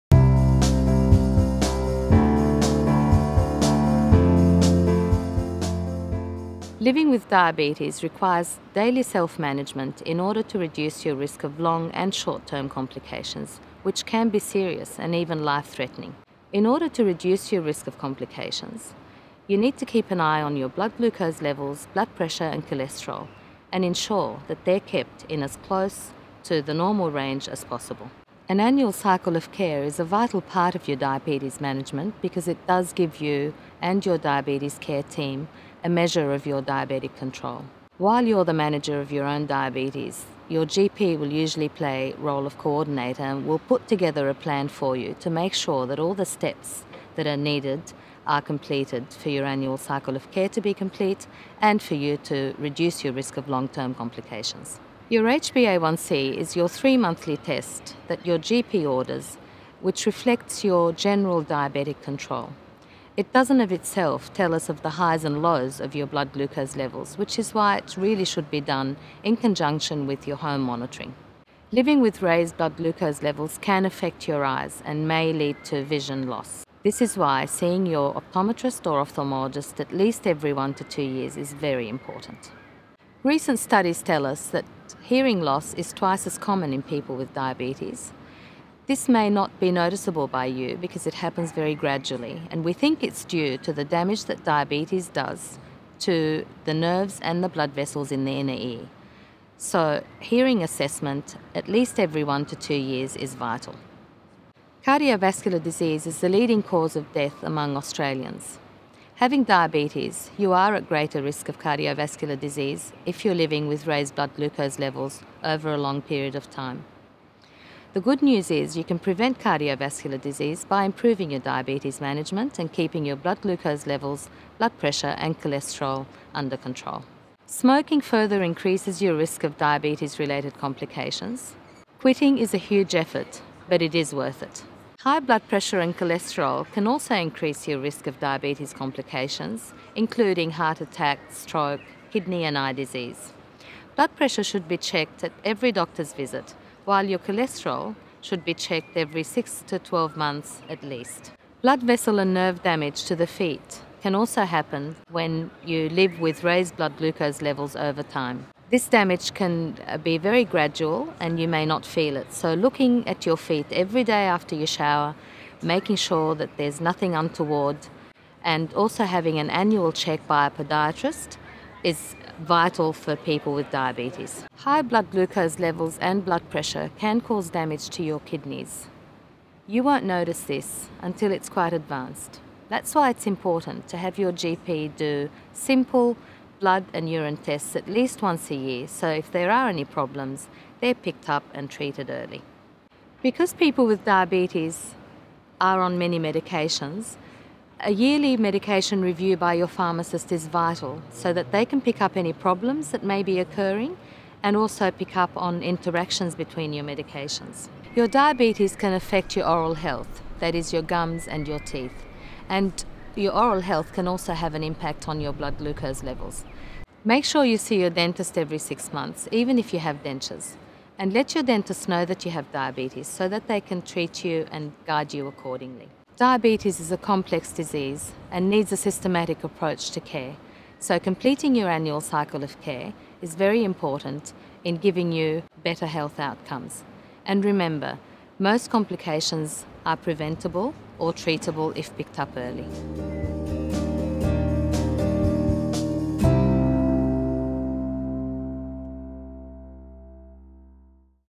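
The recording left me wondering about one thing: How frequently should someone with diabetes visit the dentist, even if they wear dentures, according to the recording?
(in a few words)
Every 6 months.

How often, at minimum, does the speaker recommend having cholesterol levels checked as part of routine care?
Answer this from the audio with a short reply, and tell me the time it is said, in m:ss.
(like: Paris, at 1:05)
Every 6 to 12 months, at 2:28.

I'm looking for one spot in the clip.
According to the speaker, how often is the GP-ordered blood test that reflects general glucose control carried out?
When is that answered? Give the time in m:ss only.
0:56.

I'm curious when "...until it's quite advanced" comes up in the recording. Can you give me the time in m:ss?
3:01.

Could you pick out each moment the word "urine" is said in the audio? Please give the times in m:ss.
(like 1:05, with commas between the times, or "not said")
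3:07.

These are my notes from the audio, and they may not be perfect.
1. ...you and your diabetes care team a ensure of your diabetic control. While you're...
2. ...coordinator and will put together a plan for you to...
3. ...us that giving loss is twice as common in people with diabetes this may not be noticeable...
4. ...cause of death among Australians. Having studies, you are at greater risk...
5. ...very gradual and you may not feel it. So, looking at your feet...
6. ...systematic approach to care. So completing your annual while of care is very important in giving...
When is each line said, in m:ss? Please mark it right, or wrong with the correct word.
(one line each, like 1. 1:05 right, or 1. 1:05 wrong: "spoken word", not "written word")
1. 0:33 wrong: "measure", not "ensure"
2. 0:42 right
3. 1:24 wrong: "hearing", not "giving"
4. 1:46 wrong: "diabetes", not "studies"
5. 2:40 right
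6. 3:48 wrong: "cycle", not "while".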